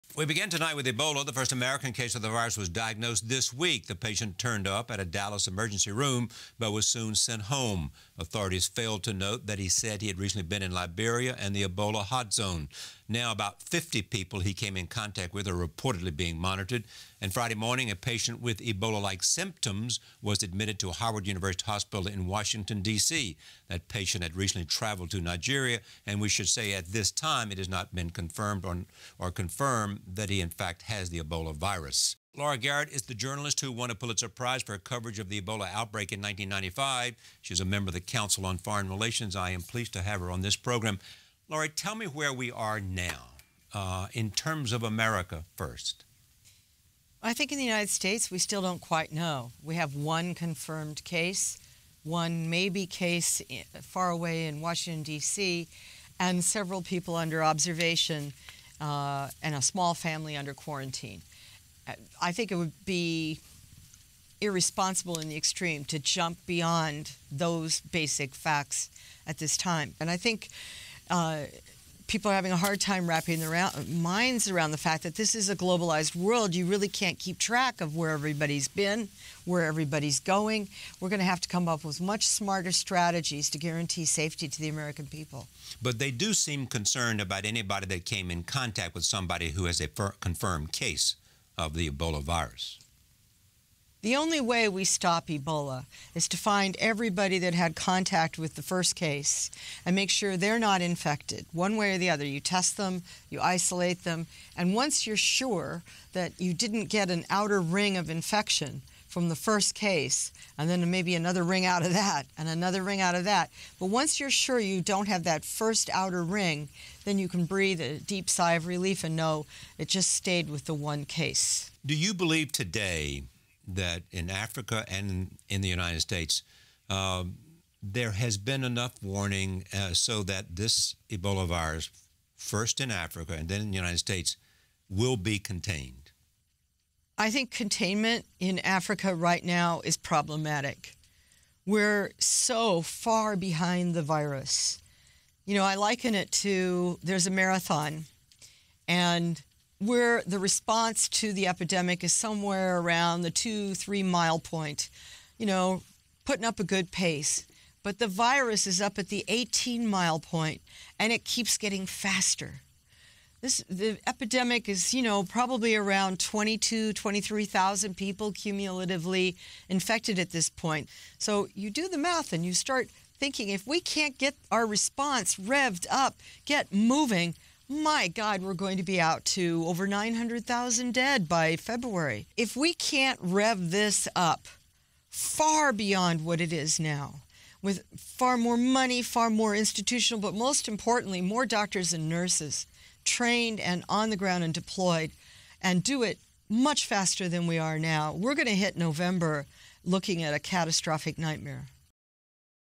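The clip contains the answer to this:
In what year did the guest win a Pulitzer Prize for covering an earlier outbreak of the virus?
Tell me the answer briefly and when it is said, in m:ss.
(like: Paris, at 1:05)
1995, at 0:36.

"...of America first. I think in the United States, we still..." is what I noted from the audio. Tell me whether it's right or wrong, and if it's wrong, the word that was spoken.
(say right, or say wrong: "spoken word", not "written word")
right.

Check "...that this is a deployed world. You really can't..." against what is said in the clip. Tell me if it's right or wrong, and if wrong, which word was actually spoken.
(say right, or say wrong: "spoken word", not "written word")
wrong: "globalized", not "deployed".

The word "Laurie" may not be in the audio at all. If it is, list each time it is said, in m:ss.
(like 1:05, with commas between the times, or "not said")
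0:32, 0:41.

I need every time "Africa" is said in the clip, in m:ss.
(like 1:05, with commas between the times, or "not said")
2:04, 2:12, 2:18.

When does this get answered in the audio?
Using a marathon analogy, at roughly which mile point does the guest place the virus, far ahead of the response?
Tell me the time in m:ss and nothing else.
2:39.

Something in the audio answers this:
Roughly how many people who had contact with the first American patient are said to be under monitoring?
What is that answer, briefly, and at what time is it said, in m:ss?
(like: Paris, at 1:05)
50, at 0:13.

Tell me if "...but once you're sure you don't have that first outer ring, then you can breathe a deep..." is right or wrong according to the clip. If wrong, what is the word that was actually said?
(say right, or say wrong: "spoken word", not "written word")
right.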